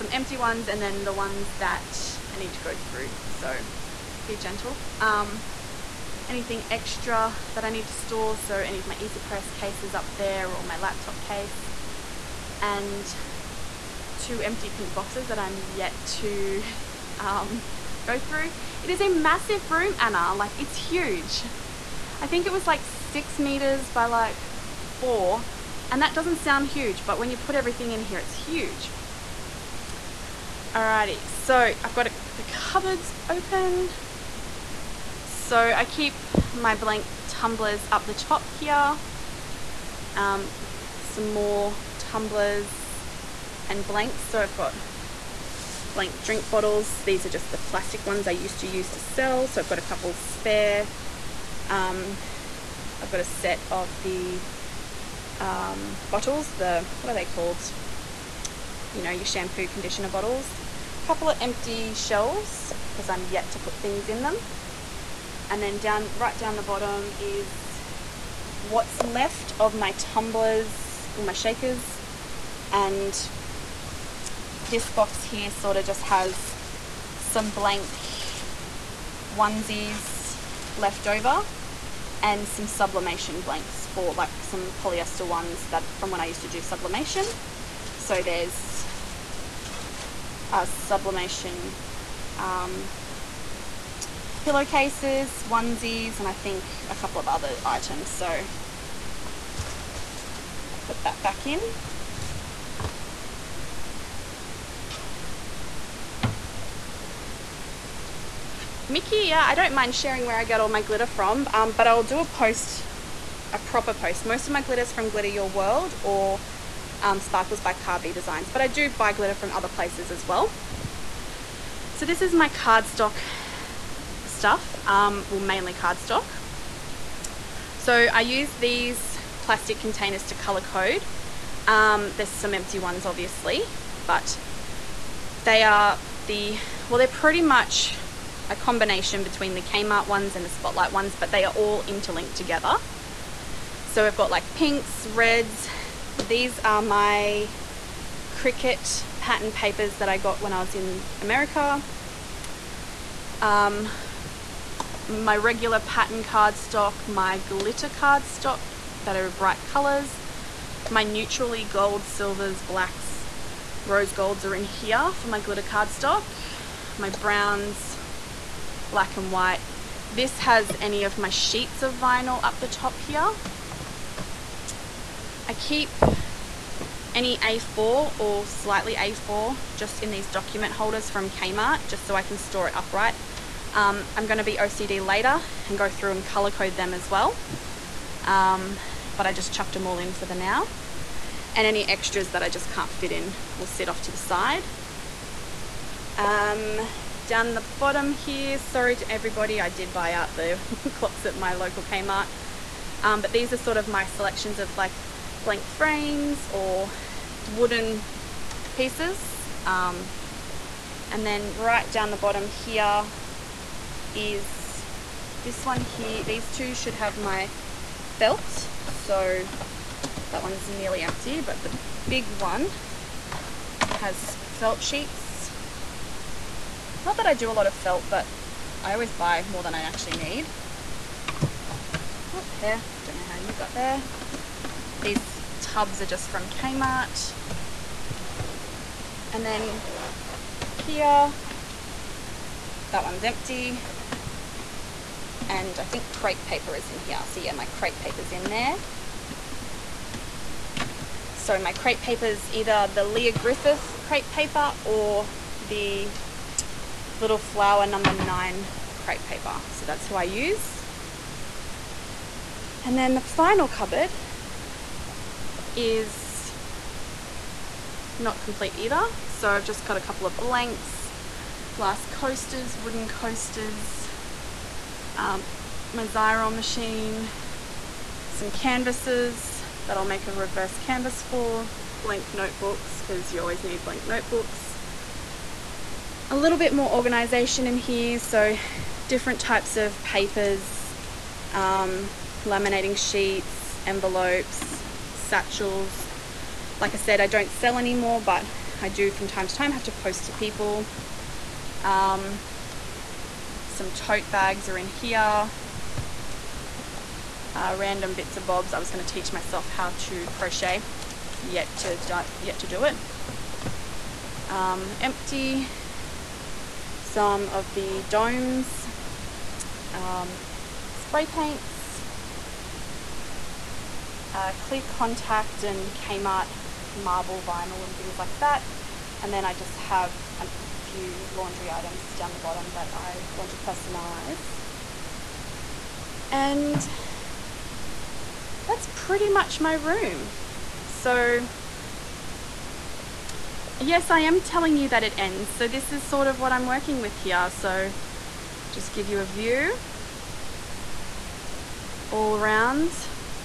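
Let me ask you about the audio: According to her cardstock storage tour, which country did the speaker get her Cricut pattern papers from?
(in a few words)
America.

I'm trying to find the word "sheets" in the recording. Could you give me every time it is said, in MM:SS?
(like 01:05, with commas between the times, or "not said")
02:51, 03:44, 04:52.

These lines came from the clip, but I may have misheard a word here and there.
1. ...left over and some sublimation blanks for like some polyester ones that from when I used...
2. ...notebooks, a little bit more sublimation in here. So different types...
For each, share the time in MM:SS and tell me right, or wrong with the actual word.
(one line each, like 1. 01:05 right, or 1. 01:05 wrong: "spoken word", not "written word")
1. 01:20 right
2. 04:44 wrong: "organization", not "sublimation".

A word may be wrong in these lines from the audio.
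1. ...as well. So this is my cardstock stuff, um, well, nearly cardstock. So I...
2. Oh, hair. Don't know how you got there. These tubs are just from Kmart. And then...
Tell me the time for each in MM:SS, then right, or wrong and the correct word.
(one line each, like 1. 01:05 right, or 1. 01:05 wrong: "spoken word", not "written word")
1. 02:00 wrong: "mainly", not "nearly"
2. 03:52 right.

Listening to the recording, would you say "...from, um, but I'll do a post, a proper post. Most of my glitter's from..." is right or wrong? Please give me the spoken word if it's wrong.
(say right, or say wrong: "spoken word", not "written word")
right.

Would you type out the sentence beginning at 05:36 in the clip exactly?
And that's pretty much my room.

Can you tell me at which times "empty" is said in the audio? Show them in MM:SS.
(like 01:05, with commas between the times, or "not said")
00:00, 00:14, 01:01, 02:12, 03:41, 04:03, 05:15.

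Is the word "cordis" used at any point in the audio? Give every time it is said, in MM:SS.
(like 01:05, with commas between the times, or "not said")
not said.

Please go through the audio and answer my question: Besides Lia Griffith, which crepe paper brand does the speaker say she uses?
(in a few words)
Little Flower Number 9.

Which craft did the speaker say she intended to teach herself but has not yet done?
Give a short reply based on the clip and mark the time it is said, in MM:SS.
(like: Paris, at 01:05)
Crochet, at 05:10.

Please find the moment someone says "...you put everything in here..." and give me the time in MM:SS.
00:27.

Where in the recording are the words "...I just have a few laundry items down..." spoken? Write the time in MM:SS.
05:29.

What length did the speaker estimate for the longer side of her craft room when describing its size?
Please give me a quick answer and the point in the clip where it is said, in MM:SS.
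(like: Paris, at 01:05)
6 meters, at 00:22.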